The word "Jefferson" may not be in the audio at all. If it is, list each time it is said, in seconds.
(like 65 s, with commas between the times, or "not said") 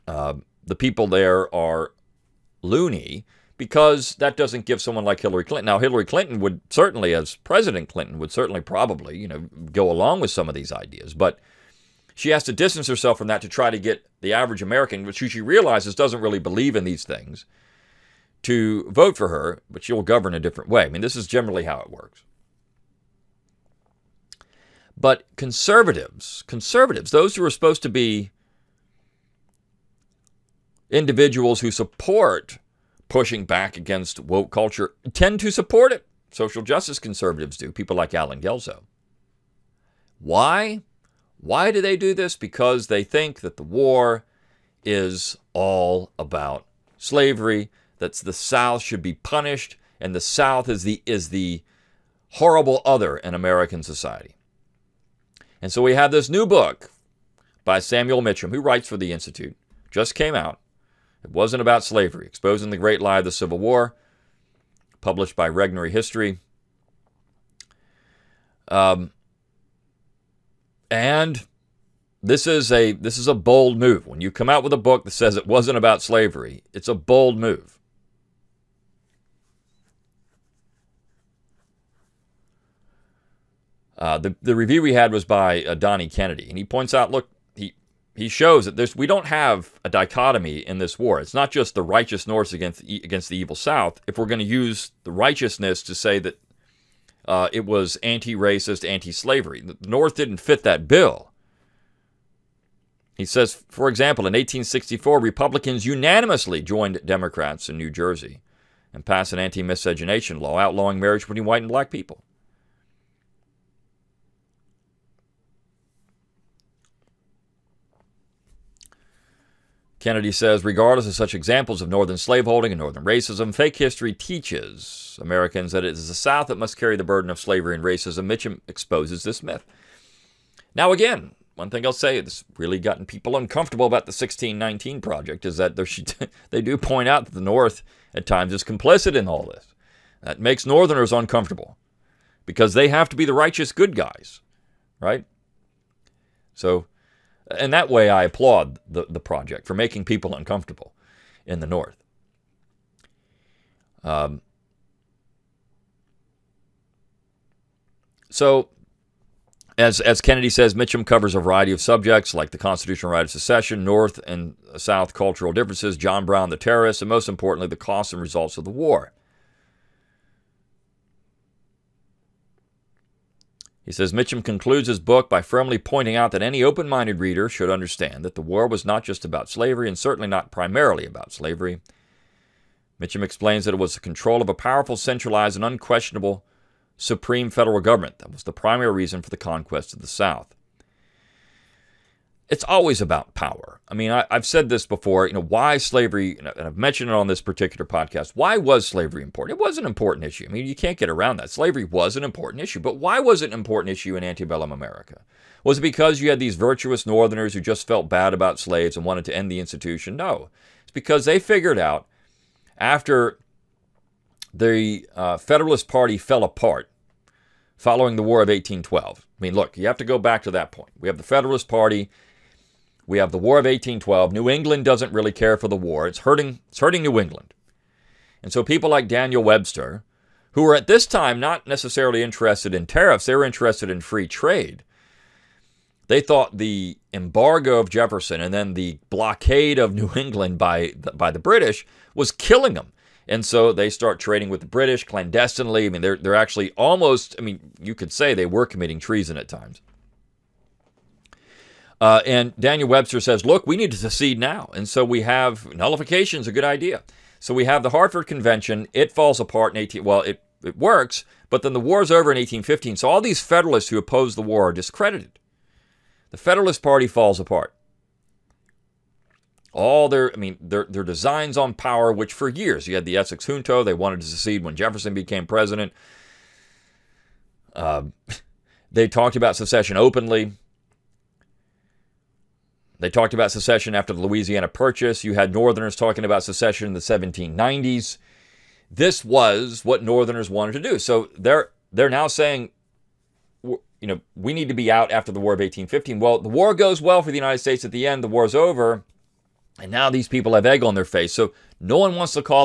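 237 s, 274 s.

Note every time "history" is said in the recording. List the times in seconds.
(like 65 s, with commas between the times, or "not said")
65 s, 123 s.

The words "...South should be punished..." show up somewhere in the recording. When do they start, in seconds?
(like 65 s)
48 s.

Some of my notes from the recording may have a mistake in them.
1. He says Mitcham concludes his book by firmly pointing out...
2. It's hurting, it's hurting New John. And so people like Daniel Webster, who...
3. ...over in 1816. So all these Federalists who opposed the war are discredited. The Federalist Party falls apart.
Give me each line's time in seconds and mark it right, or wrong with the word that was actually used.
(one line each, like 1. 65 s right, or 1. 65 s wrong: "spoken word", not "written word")
1. 173 s right
2. 226 s wrong: "England", not "John"
3. 262 s wrong: "1815", not "1816".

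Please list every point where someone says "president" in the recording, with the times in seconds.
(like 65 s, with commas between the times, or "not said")
7 s, 275 s.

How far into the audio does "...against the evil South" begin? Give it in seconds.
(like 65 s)
92 s.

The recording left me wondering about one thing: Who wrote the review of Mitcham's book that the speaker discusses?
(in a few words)
Donnie Kennedy.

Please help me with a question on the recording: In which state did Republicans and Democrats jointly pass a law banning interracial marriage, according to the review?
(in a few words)
New Jersey.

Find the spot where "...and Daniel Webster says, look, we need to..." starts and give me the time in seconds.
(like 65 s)
252 s.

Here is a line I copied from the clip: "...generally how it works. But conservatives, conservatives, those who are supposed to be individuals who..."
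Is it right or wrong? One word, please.
right.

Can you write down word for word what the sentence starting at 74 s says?
When you come out with a book that says it wasn't about slavery, it's a bold move.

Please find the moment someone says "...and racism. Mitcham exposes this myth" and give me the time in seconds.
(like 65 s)
127 s.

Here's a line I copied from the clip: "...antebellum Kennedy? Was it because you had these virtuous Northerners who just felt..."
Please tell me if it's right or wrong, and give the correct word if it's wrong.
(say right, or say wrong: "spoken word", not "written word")
wrong: "America", not "Kennedy".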